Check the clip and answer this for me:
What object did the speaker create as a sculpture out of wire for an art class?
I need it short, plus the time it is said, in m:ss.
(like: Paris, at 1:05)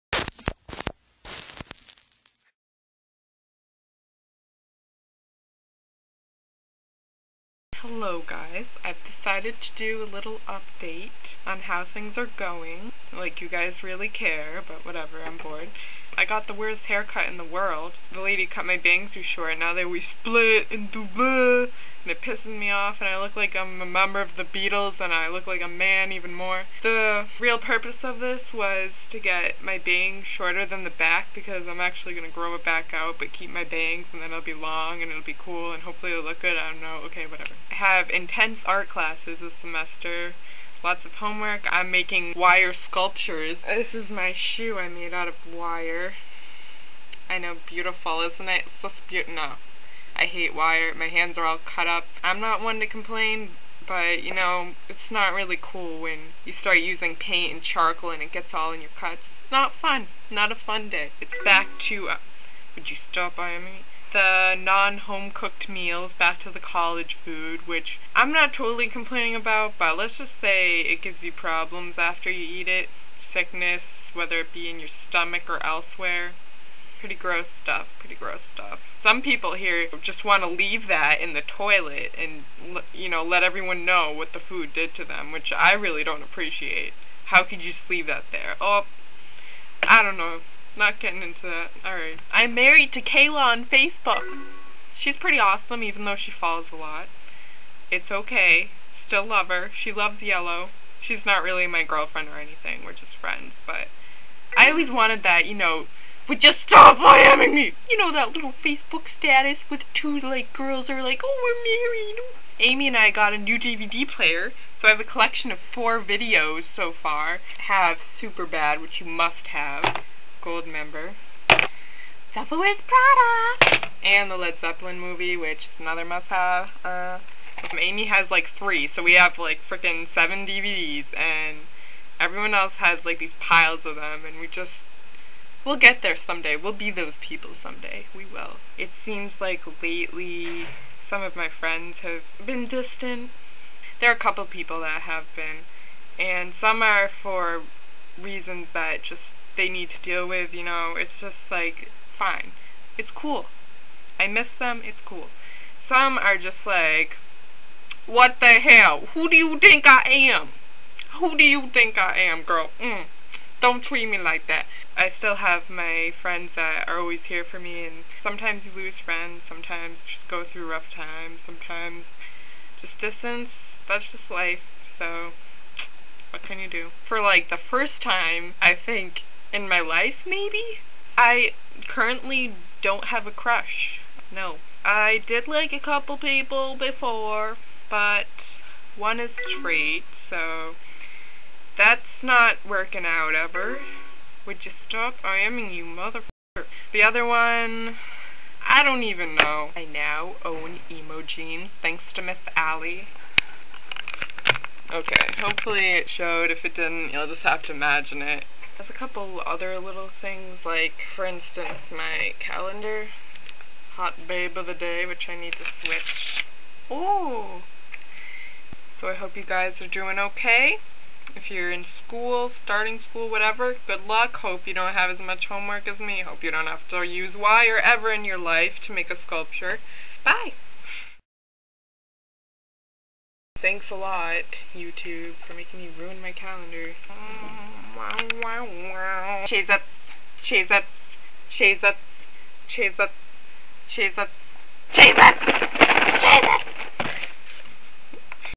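Shoe, at 0:44.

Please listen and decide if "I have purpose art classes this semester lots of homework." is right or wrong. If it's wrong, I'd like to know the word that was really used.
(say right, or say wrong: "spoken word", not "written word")
wrong: "intense", not "purpose".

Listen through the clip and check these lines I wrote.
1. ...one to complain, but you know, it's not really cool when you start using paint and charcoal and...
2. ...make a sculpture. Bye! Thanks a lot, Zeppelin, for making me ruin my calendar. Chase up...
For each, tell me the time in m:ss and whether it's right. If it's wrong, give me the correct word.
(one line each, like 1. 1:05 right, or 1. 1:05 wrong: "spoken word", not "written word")
1. 0:52 right
2. 3:48 wrong: "YouTube", not "Zeppelin".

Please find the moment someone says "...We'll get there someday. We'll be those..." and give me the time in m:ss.
2:15.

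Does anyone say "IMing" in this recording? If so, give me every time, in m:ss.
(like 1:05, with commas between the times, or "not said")
1:46, 3:15.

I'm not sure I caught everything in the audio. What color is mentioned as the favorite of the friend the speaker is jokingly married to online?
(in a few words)
Yellow.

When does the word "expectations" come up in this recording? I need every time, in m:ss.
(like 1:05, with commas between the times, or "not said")
not said.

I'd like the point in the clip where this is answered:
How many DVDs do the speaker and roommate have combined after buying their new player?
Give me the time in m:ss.
2:10.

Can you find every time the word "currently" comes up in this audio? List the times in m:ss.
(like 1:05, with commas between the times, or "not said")
3:01.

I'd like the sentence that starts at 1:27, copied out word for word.
How could you just leave that there?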